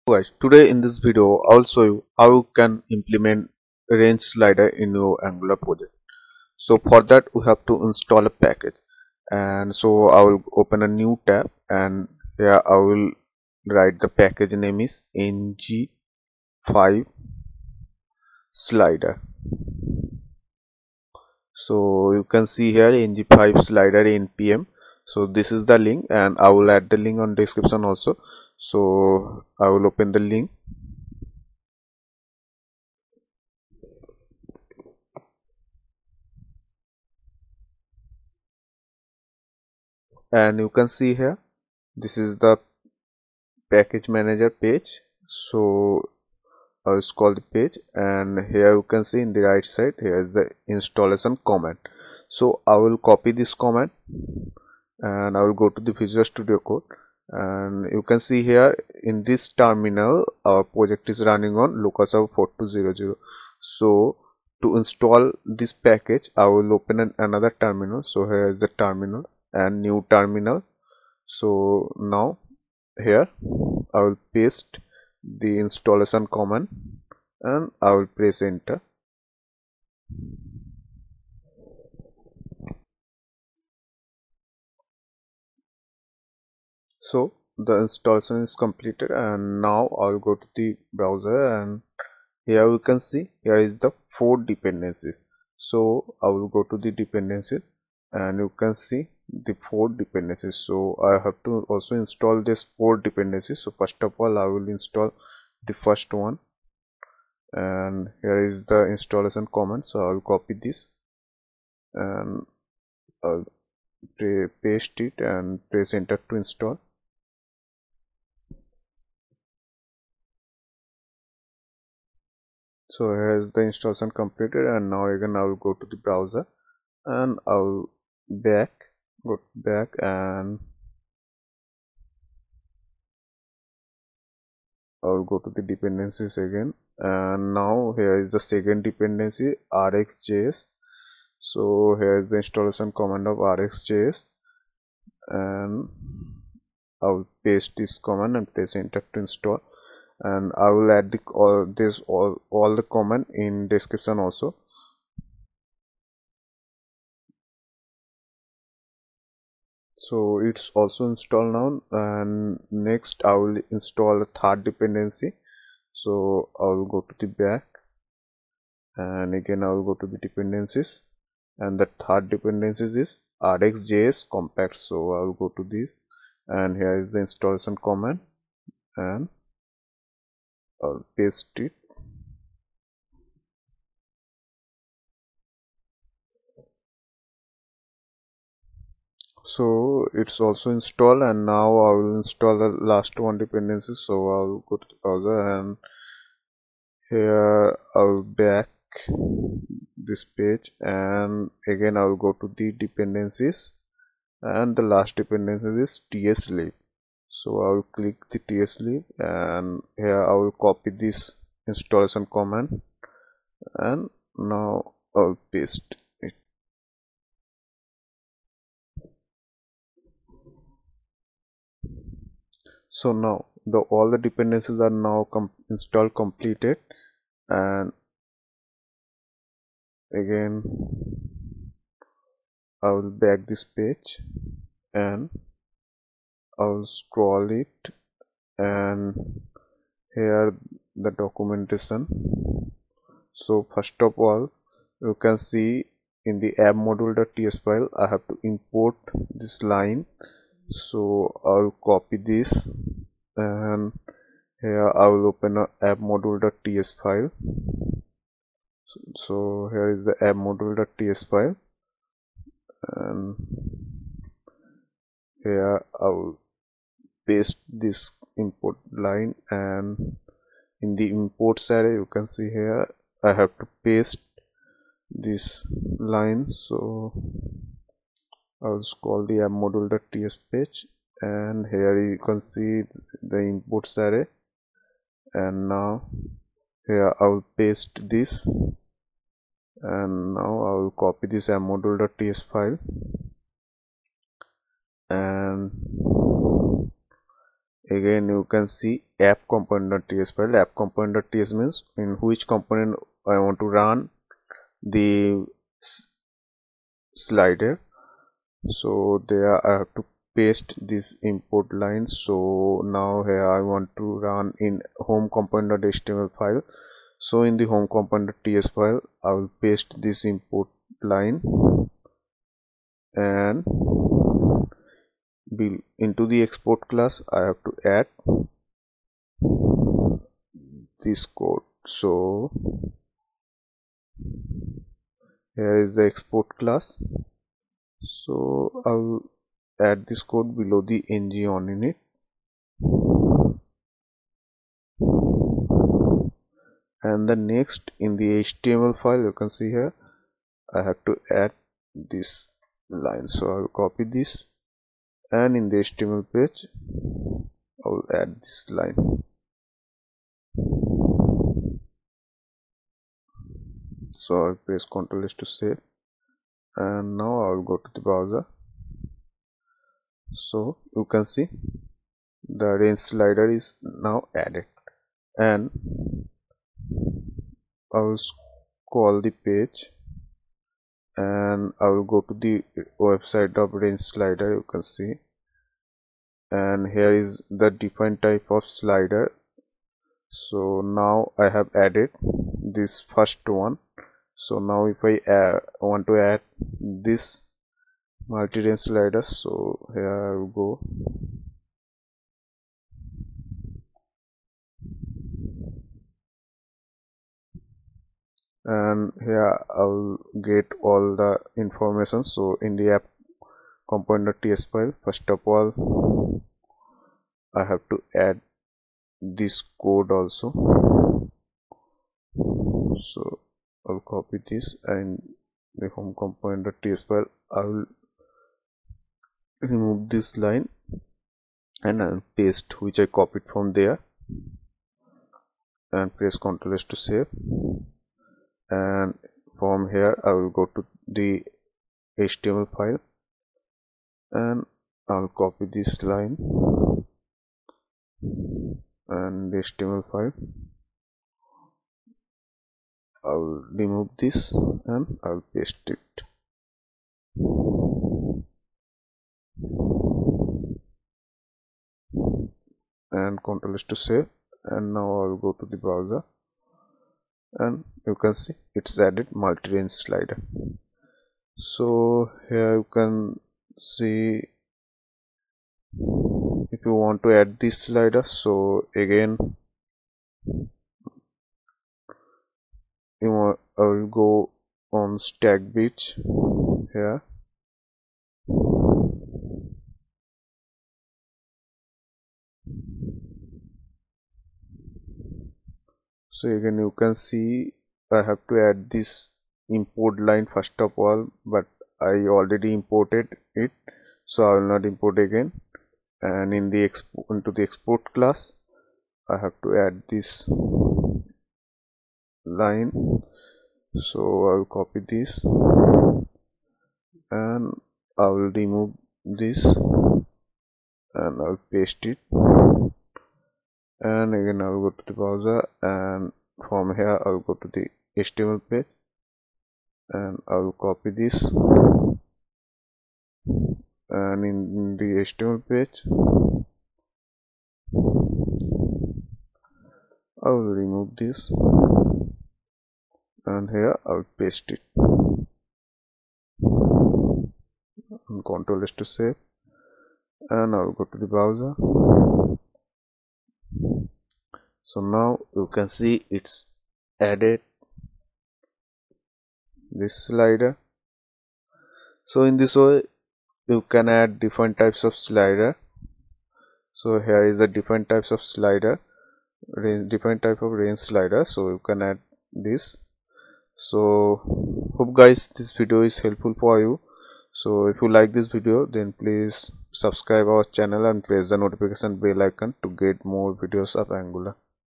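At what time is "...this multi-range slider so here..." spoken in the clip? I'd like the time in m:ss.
6:37.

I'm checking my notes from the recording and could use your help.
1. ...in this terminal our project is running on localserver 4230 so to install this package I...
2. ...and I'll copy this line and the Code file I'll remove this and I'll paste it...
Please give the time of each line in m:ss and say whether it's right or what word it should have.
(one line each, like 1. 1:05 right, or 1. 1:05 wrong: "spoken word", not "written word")
1. 0:59 wrong: "4200", not "4230"
2. 7:24 wrong: "HTML", not "Code".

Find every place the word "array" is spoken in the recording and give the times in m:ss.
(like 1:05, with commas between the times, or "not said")
4:31, 4:44.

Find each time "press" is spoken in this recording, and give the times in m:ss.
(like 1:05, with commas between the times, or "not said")
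1:18, 1:55, 2:28, 6:04, 7:16, 9:41.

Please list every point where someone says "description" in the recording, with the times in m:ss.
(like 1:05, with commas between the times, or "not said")
0:27, 2:33.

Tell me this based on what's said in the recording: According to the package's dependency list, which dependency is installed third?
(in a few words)
rxjs compat.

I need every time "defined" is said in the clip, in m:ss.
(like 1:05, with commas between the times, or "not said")
6:27.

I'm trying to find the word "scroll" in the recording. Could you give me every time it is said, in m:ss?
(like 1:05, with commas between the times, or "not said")
0:47, 3:56.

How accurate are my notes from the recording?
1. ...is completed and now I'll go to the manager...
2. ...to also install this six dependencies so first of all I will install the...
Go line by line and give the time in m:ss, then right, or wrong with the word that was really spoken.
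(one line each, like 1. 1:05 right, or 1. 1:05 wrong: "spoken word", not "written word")
1. 1:28 wrong: "browser", not "manager"
2. 1:41 wrong: "four", not "six".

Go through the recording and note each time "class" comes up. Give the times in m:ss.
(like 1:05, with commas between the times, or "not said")
5:26, 5:36, 8:28.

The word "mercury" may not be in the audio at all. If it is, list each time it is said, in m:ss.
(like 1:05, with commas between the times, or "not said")
not said.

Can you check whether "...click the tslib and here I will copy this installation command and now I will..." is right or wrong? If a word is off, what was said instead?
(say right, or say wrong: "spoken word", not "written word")
right.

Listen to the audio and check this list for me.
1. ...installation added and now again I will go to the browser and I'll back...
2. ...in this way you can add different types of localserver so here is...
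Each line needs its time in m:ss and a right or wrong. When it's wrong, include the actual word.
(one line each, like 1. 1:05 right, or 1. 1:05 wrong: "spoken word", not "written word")
1. 2:03 wrong: "completed", not "added"
2. 9:22 wrong: "slider", not "localserver".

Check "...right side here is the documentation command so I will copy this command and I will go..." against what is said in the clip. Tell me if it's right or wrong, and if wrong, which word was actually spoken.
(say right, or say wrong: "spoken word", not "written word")
wrong: "installation", not "documentation".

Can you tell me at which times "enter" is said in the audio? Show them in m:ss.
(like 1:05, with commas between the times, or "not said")
1:18, 1:55, 2:28.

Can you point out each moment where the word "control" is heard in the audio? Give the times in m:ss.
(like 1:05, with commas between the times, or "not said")
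7:43, 9:08.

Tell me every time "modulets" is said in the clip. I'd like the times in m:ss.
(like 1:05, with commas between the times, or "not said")
4:06, 4:16, 4:20.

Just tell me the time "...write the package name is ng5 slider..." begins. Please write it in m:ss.
0:13.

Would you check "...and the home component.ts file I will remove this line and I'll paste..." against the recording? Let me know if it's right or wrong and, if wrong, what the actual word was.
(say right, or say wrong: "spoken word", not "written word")
right.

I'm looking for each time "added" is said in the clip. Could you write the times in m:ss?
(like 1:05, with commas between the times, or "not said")
6:14, 6:31, 7:48, 9:17.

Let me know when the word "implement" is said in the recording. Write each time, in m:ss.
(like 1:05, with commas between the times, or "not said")
0:02.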